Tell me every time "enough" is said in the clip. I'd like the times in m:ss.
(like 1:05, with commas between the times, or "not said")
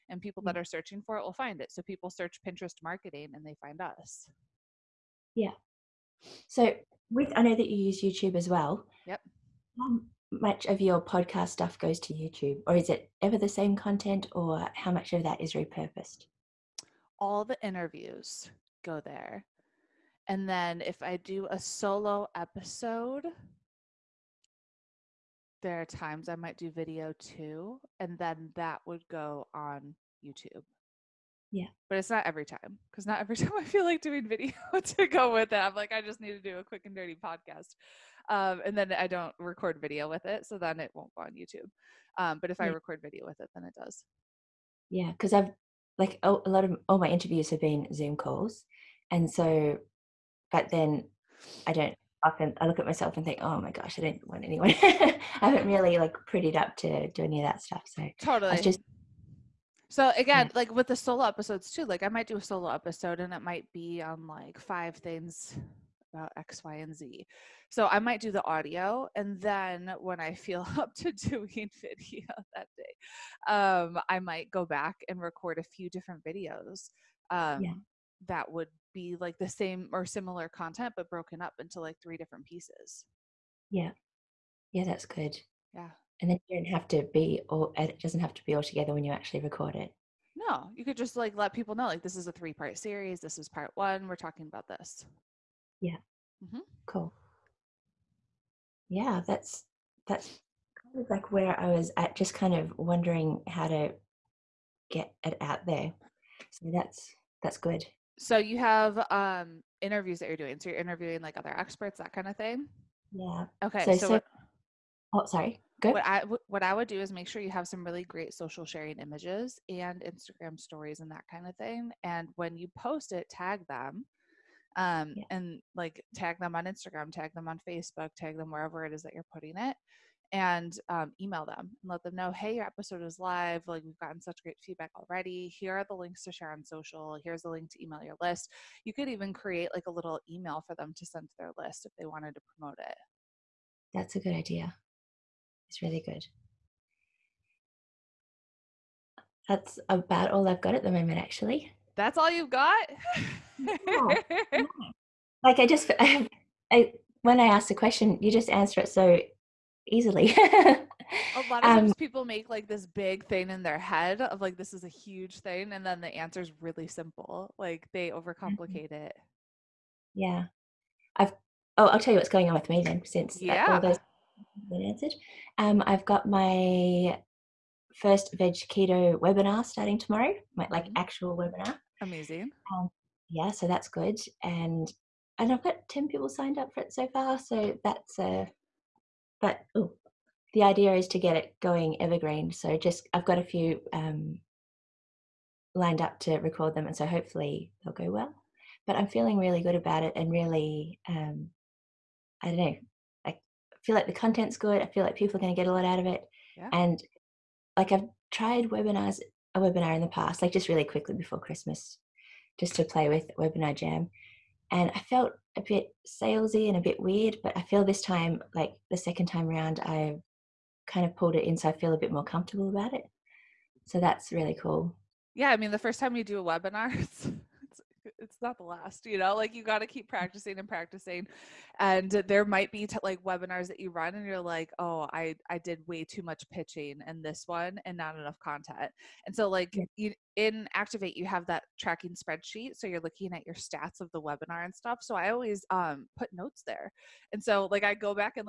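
3:58.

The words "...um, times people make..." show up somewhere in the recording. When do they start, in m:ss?
2:41.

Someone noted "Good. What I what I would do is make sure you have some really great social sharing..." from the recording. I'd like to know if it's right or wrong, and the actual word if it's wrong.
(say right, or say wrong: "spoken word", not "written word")
right.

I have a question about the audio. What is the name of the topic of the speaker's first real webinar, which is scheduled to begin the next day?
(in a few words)
veg keto.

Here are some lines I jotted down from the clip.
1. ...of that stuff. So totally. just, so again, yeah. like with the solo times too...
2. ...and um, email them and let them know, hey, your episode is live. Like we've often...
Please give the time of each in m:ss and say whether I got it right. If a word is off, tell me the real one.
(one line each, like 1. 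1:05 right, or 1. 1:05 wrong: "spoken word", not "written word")
1. 0:57 wrong: "episodes", not "times"
2. 2:10 wrong: "gotten", not "often".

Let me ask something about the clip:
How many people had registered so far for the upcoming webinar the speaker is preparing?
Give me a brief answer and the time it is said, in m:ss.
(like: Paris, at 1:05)
10, at 3:05.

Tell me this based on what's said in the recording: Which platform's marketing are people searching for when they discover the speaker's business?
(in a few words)
Pinterest.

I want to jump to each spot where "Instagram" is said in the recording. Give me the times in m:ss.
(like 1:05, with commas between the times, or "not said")
2:00, 2:06.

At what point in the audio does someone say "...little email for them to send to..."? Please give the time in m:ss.
2:19.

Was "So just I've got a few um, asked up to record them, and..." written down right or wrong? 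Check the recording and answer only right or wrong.
wrong.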